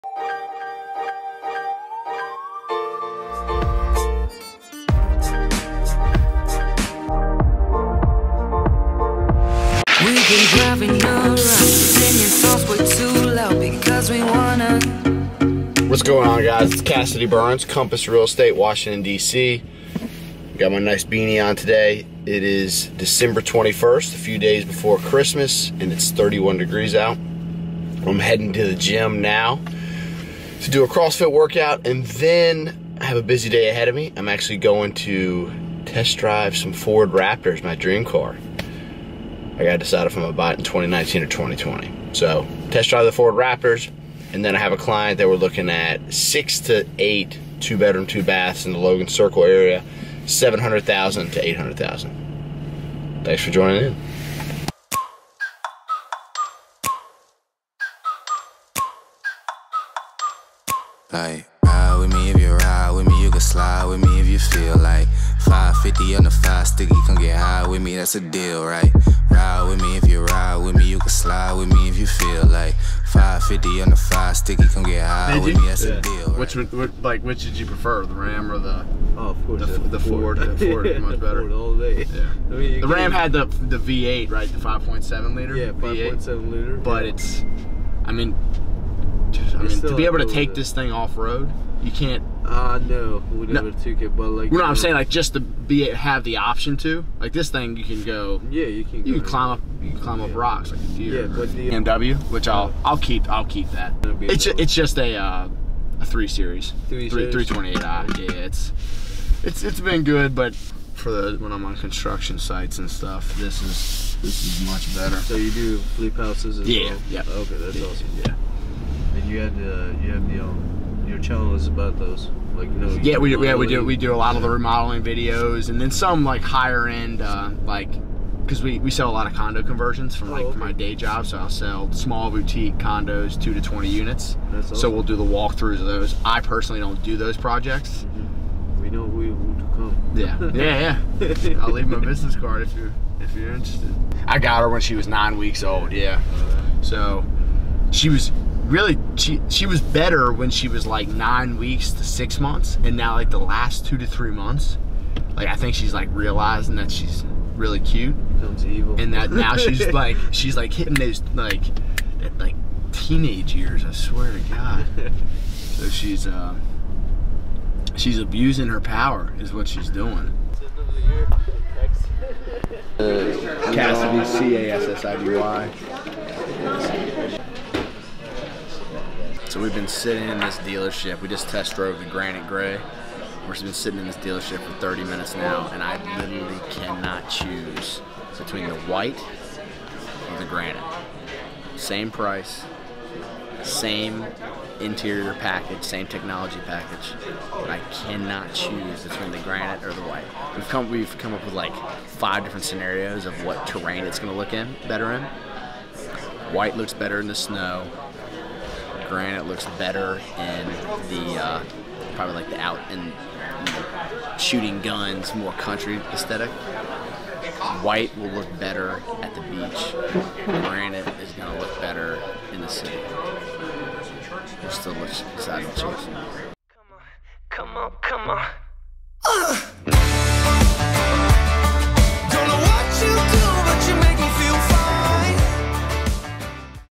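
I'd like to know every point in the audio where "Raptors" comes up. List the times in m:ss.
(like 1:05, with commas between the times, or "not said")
0:37, 0:43.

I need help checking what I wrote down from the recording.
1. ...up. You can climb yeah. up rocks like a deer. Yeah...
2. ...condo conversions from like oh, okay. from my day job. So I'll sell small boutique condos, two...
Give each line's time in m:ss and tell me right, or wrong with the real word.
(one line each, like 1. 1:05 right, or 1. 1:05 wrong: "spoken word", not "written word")
1. 1:39 right
2. 2:09 right.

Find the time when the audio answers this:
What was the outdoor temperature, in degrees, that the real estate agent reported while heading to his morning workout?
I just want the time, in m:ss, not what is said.
0:26.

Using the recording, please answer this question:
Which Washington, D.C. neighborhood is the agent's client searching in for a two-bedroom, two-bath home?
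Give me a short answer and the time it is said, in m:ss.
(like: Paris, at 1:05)
Logan Circle, at 0:48.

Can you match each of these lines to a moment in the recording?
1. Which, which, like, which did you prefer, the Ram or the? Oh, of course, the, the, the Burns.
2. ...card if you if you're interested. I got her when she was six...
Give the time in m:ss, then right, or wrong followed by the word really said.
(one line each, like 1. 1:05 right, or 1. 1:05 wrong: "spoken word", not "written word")
1. 1:16 wrong: "Ford", not "Burns"
2. 2:22 wrong: "nine", not "six".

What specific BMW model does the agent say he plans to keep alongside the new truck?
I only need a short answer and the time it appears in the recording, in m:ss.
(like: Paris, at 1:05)
328i, at 1:47.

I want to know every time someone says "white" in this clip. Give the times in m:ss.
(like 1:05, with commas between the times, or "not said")
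3:08, 3:20, 3:26, 3:37.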